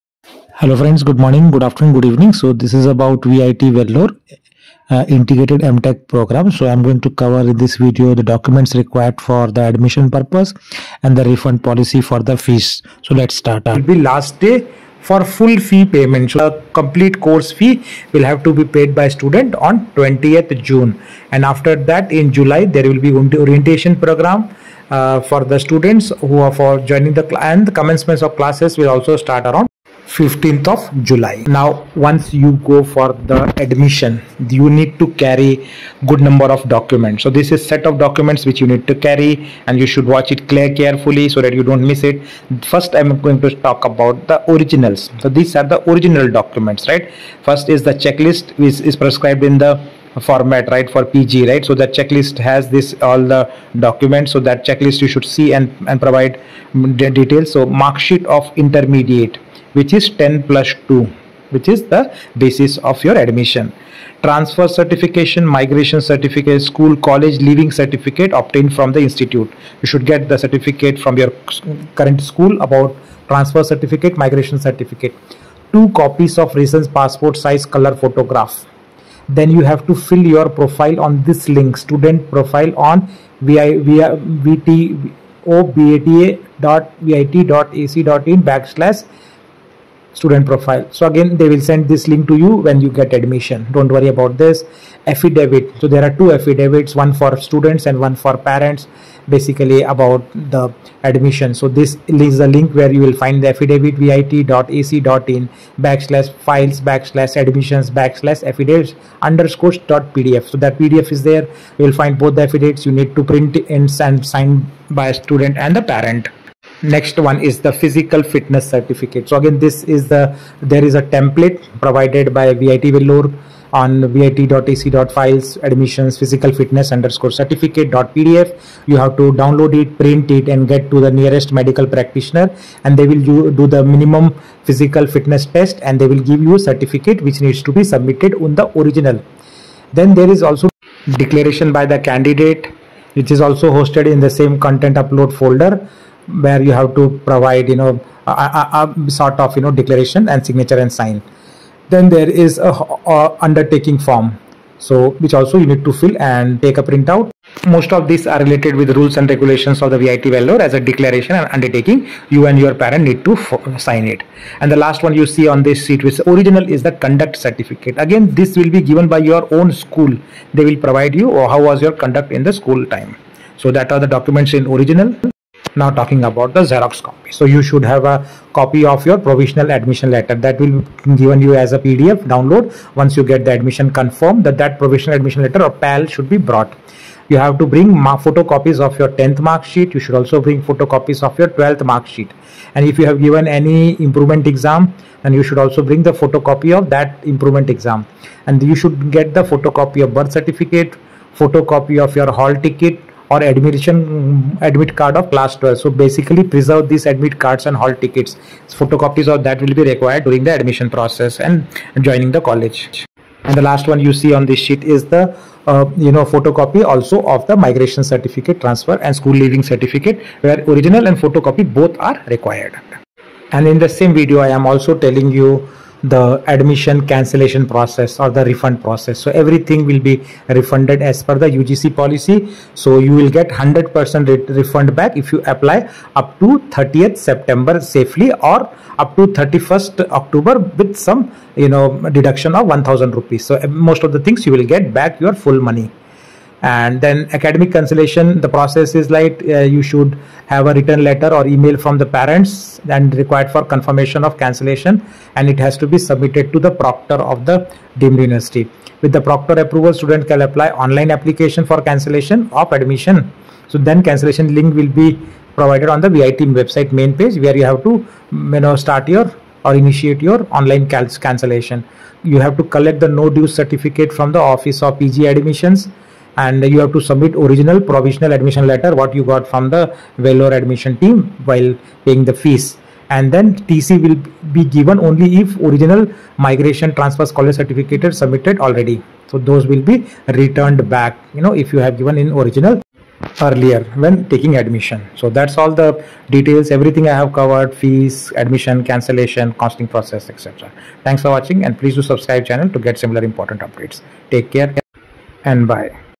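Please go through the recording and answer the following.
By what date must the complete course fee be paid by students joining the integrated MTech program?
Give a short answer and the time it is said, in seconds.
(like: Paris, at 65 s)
20th June, at 19 s.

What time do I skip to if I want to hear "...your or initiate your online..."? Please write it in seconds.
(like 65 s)
269 s.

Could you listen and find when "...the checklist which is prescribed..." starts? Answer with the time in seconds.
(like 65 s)
47 s.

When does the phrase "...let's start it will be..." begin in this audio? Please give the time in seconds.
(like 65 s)
13 s.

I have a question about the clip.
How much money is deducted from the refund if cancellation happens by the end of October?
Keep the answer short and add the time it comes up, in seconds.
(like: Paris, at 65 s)
1000 rupees, at 242 s.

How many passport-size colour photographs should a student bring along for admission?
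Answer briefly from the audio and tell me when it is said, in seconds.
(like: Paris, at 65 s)
2, at 75 s.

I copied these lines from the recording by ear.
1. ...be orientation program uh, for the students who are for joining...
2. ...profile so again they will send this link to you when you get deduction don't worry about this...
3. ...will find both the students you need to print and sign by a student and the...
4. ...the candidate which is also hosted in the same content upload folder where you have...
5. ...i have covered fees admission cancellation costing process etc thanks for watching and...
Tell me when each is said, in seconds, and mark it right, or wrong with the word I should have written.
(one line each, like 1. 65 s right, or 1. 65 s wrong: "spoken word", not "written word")
1. 23 s right
2. 90 s wrong: "admission", not "deduction"
3. 111 s wrong: "affidavits", not "students"
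4. 141 s right
5. 297 s right.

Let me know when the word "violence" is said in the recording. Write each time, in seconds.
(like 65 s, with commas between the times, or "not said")
not said.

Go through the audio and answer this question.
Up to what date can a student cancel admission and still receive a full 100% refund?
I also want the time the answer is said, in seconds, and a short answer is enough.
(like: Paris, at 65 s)
30th September, at 236 s.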